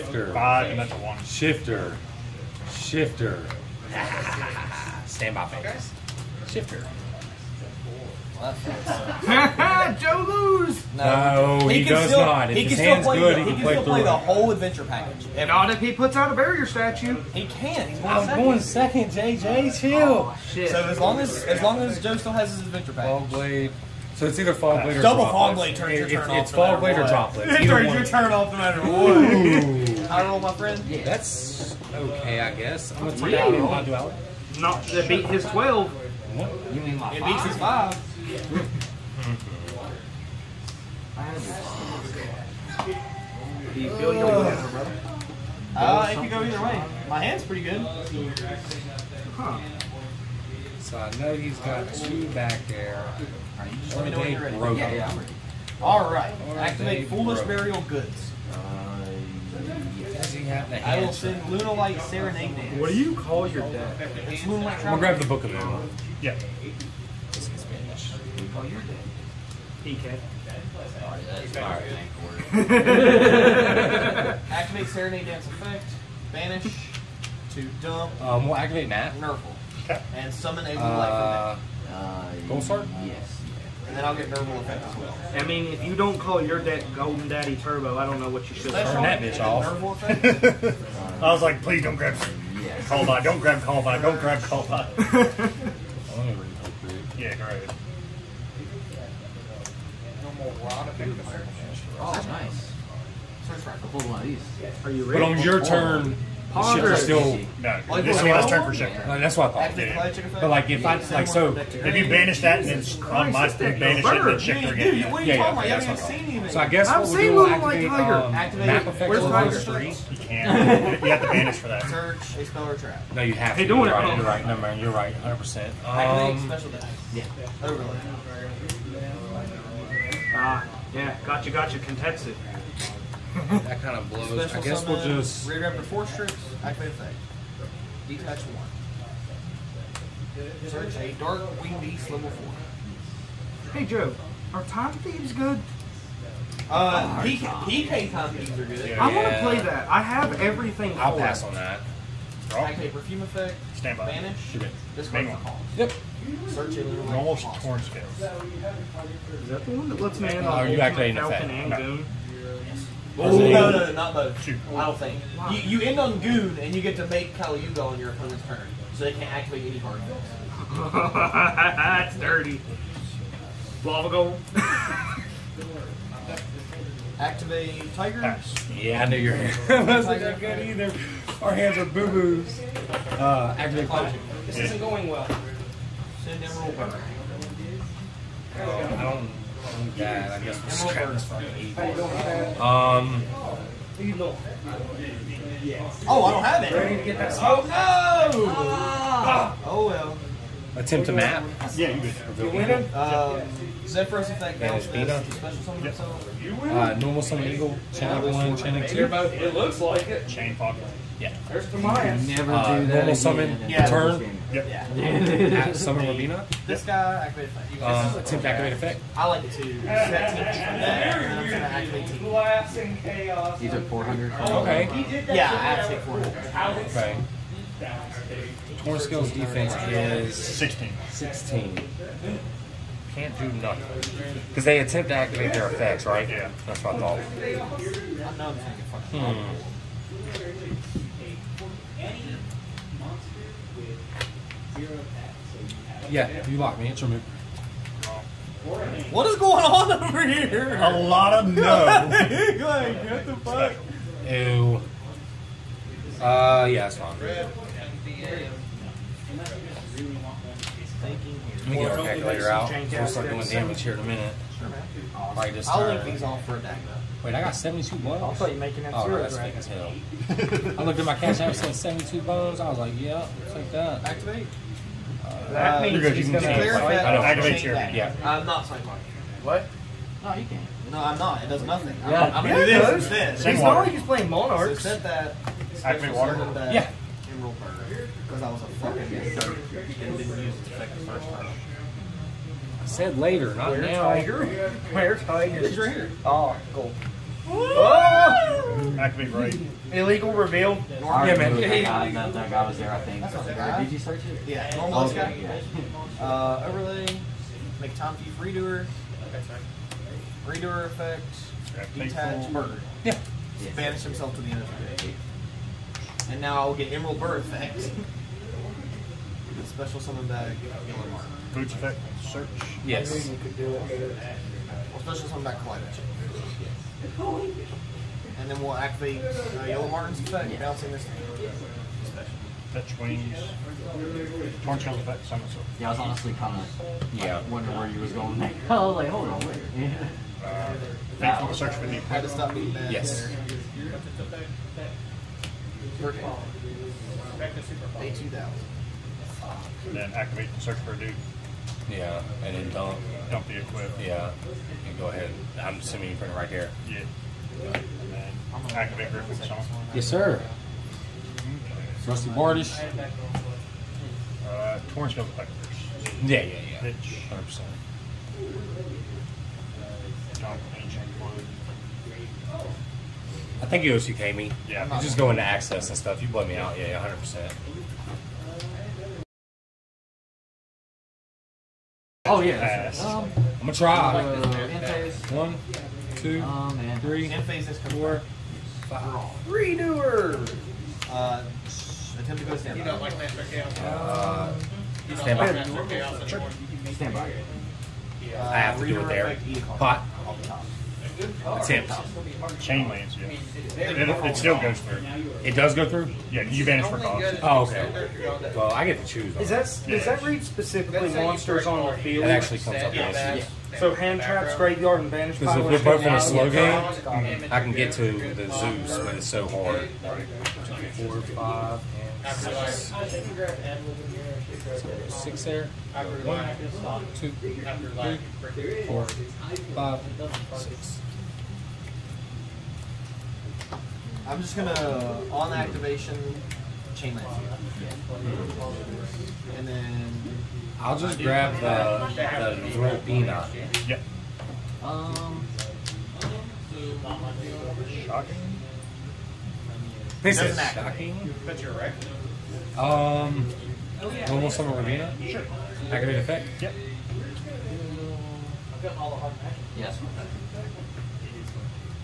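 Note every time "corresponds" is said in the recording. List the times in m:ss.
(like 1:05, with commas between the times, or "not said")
not said.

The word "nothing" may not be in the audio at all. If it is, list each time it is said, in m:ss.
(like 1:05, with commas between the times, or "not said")
3:53, 4:41.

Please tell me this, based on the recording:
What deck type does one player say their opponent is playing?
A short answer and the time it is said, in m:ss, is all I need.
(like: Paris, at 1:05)
Monarchs, at 4:44.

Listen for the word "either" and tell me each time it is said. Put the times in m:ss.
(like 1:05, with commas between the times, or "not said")
0:24, 0:46, 3:00.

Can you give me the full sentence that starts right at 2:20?
Search a dark winged beast level four.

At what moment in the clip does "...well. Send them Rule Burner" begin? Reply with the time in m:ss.
3:05.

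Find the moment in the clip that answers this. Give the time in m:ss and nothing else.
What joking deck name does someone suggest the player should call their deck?
1:26.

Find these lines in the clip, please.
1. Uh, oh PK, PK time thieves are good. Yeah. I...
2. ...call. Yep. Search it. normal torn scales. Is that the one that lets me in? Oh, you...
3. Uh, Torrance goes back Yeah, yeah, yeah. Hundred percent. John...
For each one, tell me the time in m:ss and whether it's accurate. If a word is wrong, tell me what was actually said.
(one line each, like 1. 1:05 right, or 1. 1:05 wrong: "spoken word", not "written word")
1. 2:26 right
2. 2:35 right
3. 6:04 right.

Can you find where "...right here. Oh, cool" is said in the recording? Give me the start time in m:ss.
4:55.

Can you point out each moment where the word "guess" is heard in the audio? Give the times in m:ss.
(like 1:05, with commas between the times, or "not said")
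0:32, 1:56, 2:14, 3:09.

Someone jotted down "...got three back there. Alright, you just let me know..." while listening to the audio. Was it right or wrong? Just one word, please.
wrong.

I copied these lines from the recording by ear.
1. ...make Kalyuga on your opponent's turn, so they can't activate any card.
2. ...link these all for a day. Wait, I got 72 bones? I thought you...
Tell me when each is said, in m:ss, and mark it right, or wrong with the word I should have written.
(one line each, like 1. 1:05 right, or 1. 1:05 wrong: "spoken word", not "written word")
1. 2:47 right
2. 4:25 right.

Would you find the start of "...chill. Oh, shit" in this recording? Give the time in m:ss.
0:19.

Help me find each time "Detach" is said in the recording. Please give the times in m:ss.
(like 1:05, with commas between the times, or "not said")
2:18, 5:11.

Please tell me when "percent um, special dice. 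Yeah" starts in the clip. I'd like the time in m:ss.
2:05.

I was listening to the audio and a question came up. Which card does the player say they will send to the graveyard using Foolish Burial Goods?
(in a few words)
Lunalight Serenade Dance.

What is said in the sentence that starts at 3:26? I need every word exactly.
Uh, normal summon Eagle, Chain 1, Chain 2.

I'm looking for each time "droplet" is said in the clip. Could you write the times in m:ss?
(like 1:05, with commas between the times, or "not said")
0:27.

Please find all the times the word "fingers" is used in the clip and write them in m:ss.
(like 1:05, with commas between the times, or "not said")
0:05.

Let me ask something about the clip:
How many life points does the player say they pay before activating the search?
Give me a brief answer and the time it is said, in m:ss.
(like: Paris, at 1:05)
2000, at 5:48.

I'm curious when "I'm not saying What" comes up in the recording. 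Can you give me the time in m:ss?
4:38.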